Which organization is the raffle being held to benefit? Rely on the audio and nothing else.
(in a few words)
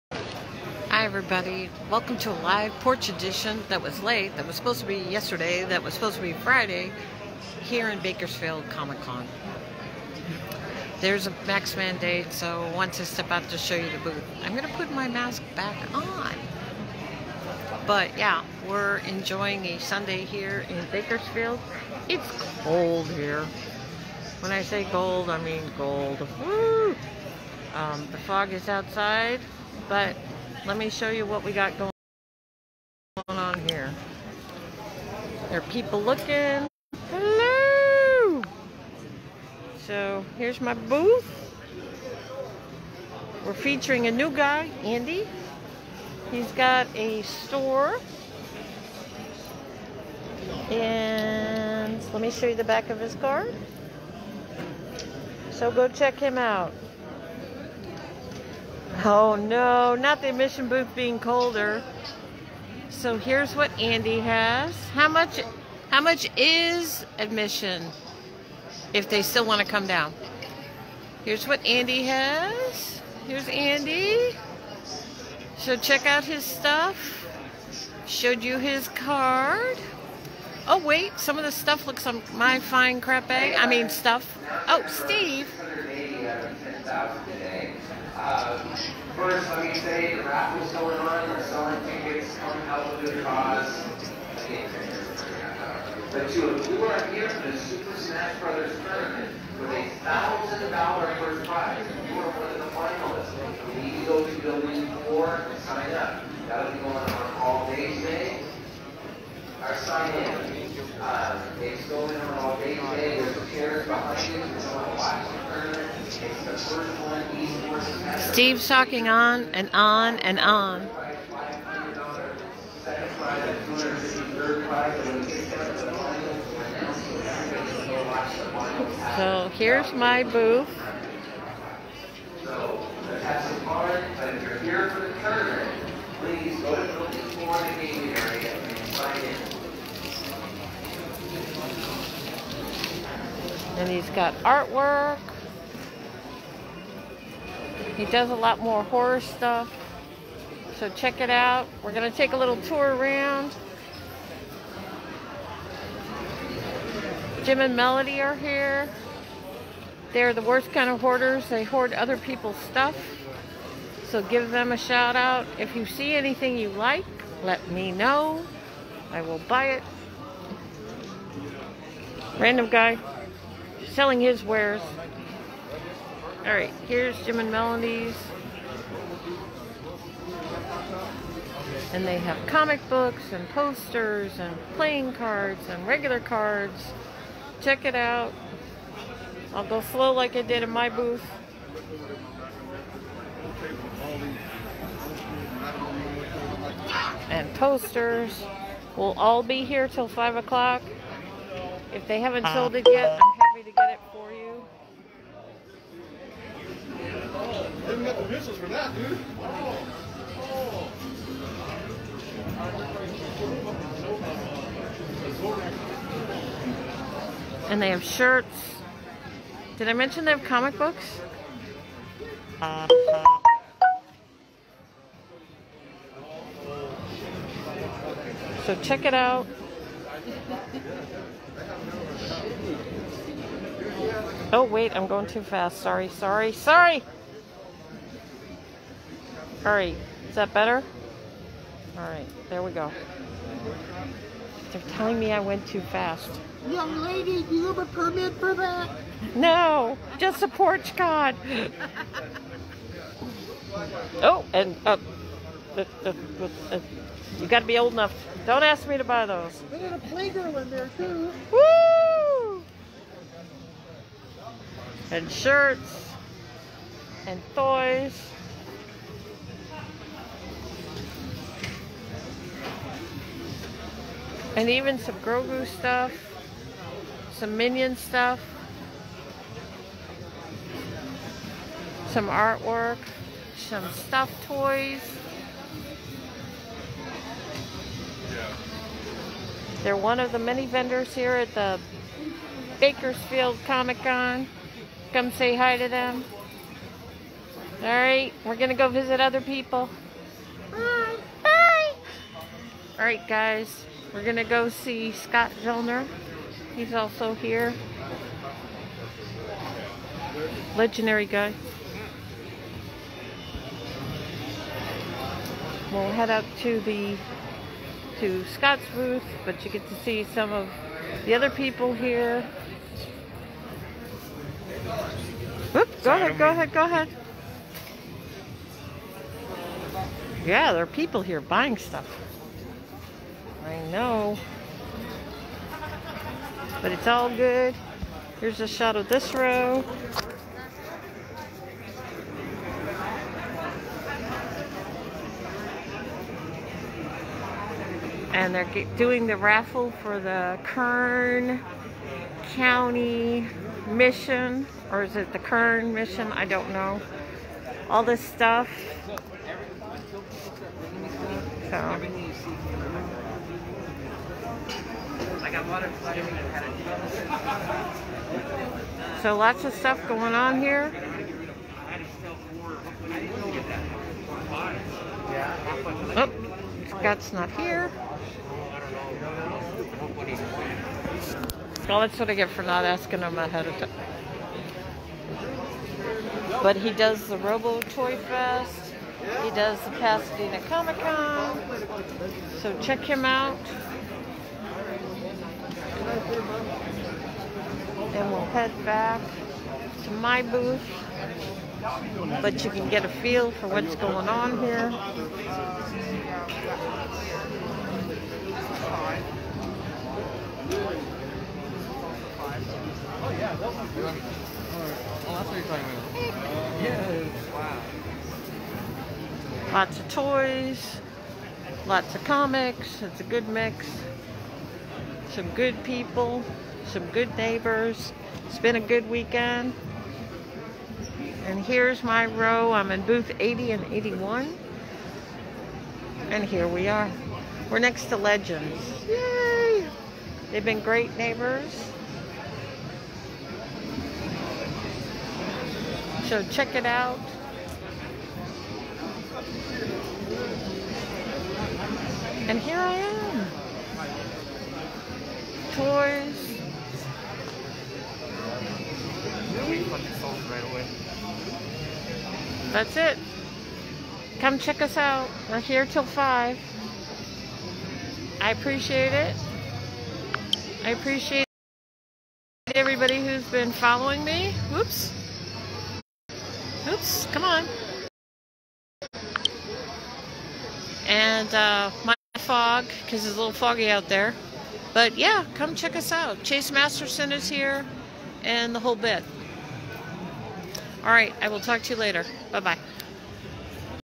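Kern County Mission.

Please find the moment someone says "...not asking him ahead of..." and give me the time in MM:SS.
06:22.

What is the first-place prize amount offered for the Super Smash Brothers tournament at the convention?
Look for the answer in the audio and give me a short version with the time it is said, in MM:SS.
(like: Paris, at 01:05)
$1,000, at 01:39.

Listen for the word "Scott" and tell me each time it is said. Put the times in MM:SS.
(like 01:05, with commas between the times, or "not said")
05:05, 05:18, 06:16.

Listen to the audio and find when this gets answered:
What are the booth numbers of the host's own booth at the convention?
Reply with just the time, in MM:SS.
07:13.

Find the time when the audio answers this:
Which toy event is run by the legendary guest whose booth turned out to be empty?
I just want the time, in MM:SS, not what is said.
06:27.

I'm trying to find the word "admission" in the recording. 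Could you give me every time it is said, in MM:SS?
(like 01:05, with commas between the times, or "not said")
01:00, 01:07.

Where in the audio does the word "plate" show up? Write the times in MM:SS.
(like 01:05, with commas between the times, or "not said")
not said.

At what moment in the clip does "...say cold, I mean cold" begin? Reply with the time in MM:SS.
00:24.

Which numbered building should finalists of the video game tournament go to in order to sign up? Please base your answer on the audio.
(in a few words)
Building 4.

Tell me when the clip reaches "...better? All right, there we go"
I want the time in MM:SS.
04:00.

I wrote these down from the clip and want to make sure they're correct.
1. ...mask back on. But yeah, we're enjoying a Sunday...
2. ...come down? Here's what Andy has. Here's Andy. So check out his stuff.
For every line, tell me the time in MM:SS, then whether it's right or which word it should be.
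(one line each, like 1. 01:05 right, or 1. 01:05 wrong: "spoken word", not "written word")
1. 00:15 right
2. 01:09 right.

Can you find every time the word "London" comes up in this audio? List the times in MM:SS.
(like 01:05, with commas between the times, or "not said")
not said.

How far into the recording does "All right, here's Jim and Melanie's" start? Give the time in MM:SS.
02:56.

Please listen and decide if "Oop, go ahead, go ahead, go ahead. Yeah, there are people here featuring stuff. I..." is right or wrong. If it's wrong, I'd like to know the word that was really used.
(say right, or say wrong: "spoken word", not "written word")
wrong: "buying", not "featuring".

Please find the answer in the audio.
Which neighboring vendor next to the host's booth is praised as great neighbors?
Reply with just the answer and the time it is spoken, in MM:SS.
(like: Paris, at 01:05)
Legends, at 07:18.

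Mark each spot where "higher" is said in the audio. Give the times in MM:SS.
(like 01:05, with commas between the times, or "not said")
not said.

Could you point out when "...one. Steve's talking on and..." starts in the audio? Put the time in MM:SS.
01:57.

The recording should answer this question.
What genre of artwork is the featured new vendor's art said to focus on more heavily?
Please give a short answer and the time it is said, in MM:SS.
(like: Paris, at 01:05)
Horror, at 02:28.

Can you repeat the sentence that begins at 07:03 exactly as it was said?
It's a good mix some good people, some good neighbors.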